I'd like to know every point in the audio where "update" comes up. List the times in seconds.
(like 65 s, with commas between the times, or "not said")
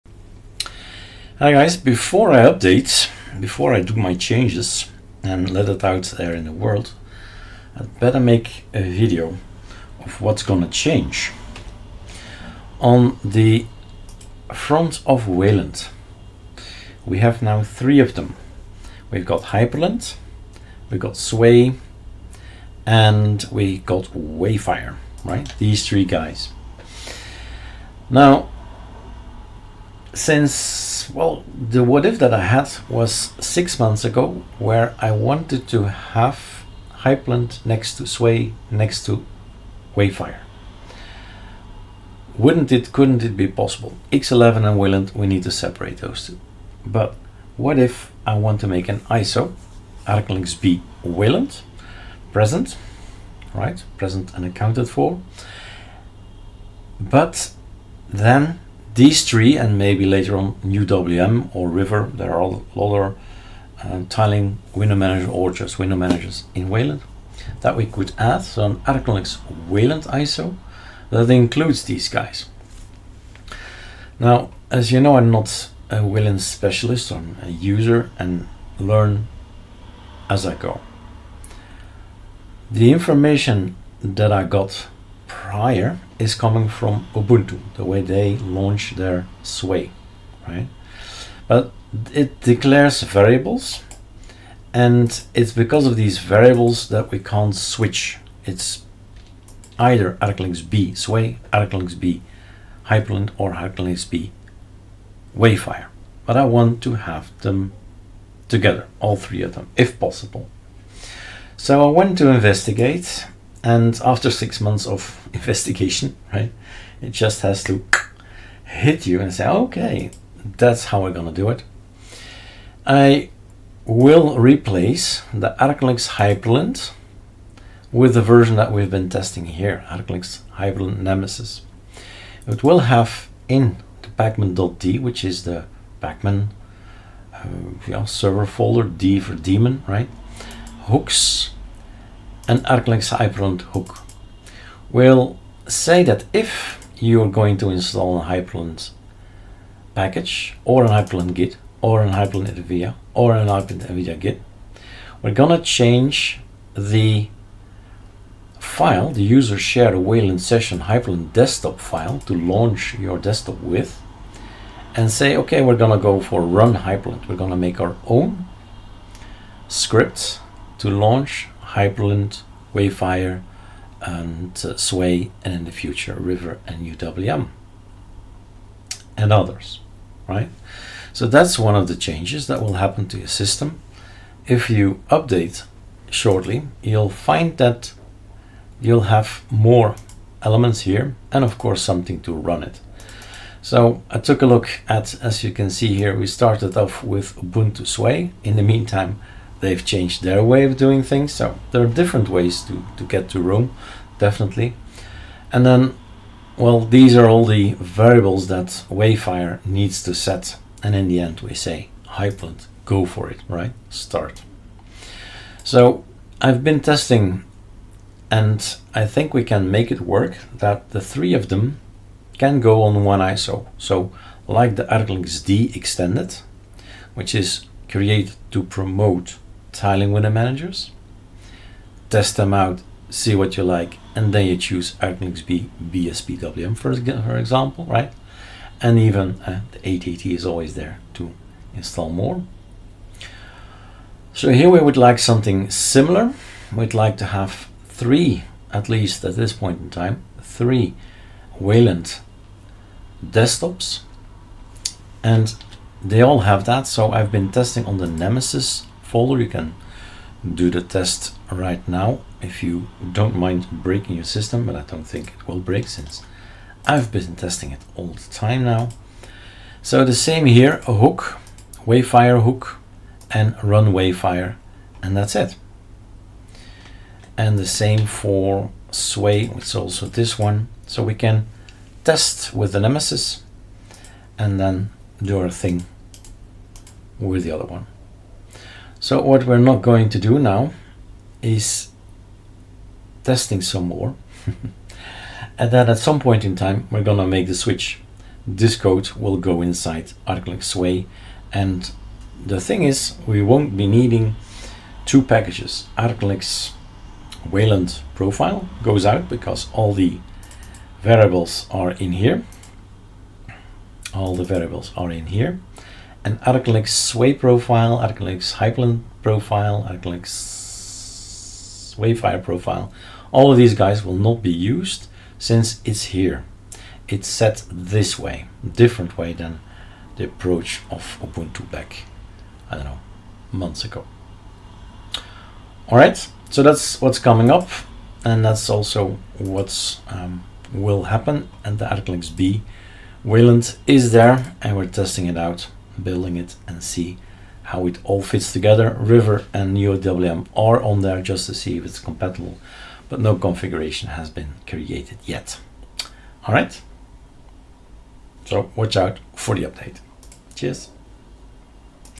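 2 s, 185 s, 359 s.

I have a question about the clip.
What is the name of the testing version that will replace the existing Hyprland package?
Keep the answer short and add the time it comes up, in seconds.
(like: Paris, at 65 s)
ArcoLinux Hyprland Nemesis, at 129 s.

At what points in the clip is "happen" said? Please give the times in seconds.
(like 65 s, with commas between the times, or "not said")
182 s, 341 s.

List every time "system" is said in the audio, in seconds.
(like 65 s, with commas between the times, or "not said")
183 s, 264 s.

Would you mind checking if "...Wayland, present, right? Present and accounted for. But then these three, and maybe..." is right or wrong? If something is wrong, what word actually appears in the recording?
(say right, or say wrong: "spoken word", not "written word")
right.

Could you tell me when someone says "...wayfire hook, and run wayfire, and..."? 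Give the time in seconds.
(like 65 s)
271 s.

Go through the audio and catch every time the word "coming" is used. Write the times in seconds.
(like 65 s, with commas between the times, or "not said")
86 s, 337 s.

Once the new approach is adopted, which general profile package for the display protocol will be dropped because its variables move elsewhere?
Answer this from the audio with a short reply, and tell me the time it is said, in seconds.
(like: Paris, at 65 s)
ArcoLinux Wayland profile, at 305 s.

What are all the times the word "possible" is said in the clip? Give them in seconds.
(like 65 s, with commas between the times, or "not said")
43 s, 109 s.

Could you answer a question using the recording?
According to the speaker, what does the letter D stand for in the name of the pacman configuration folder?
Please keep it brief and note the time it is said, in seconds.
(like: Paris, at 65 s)
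daemon, at 139 s.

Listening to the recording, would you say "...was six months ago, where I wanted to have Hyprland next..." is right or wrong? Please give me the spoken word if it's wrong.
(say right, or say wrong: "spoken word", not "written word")
right.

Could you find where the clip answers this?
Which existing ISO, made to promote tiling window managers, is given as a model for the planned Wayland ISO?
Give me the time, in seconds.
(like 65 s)
224 s.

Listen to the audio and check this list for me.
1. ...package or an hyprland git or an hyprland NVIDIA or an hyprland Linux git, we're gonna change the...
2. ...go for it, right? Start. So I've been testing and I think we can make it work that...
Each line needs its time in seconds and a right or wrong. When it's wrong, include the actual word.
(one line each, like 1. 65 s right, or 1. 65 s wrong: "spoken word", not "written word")
1. 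149 s wrong: "NVIDIA", not "Linux"
2. 212 s right.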